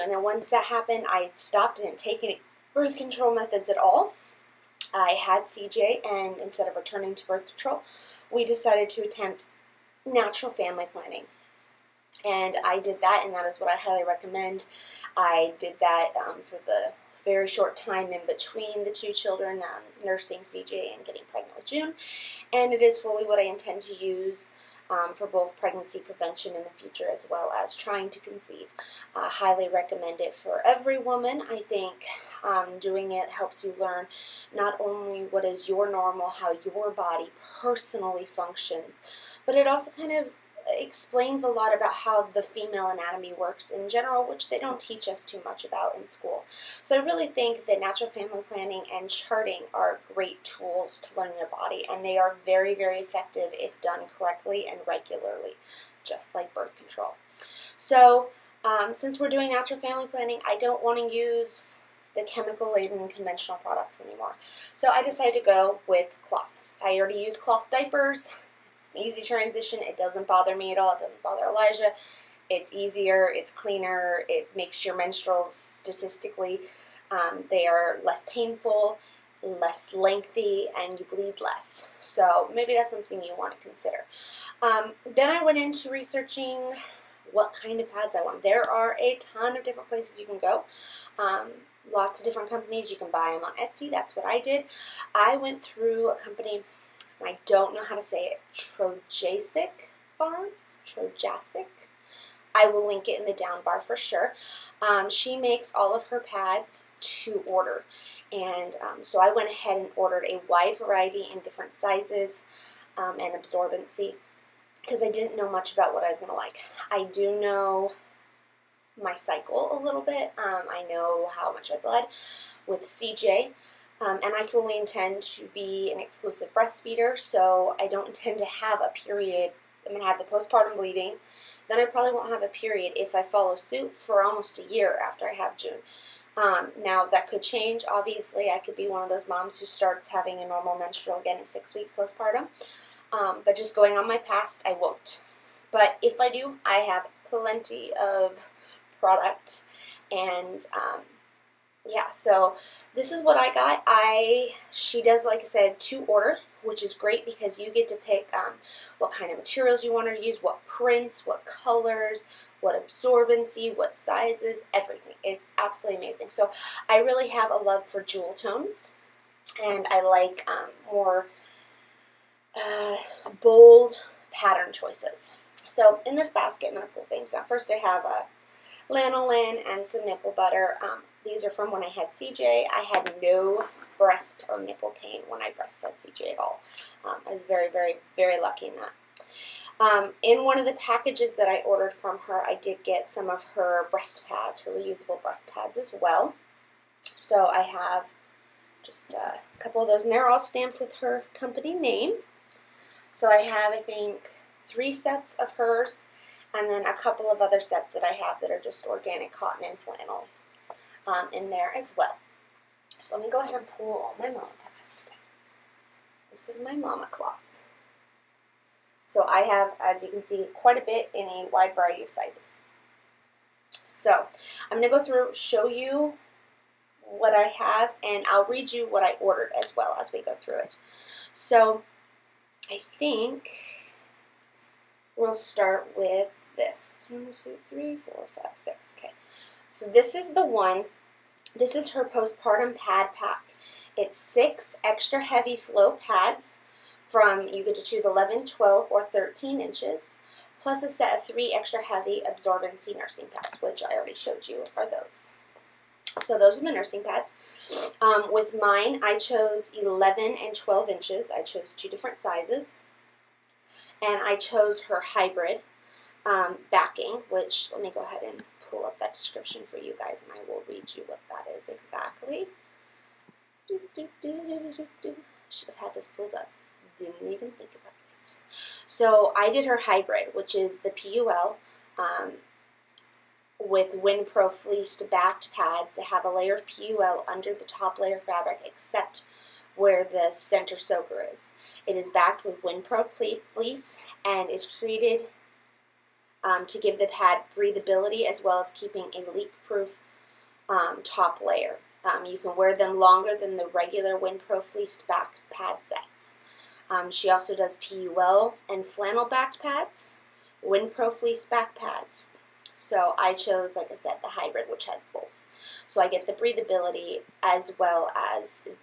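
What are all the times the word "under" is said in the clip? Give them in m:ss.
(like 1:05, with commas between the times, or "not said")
4:47.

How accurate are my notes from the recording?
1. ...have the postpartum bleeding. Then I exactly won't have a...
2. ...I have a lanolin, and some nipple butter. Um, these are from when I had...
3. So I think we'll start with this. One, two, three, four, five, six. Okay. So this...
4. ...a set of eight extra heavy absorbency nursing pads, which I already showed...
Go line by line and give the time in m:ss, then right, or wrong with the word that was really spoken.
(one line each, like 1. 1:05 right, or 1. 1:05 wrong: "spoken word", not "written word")
1. 2:10 wrong: "probably", not "exactly"
2. 2:57 right
3. 3:51 right
4. 4:10 wrong: "three", not "eight".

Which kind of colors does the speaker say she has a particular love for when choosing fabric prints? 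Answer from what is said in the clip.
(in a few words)
jewel tones.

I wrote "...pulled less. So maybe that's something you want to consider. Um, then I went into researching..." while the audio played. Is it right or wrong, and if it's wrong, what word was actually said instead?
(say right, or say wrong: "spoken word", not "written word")
wrong: "bleed", not "pulled".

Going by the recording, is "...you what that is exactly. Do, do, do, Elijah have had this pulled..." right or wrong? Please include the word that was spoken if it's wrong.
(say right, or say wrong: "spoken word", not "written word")
wrong: "Should", not "Elijah".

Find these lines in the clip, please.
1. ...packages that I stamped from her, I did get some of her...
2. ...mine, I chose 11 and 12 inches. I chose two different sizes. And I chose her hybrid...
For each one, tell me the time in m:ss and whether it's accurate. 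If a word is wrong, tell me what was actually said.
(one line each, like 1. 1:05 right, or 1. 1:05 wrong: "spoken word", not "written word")
1. 3:10 wrong: "ordered", not "stamped"
2. 4:18 right.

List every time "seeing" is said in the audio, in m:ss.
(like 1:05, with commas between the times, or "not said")
not said.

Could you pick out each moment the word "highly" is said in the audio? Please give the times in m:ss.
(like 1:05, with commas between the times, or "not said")
0:13, 0:29.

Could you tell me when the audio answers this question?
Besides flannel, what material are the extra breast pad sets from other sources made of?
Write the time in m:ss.
3:28.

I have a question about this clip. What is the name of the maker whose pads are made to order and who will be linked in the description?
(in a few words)
Trojacek Farms.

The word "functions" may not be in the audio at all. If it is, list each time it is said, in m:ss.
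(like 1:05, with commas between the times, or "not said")
0:38.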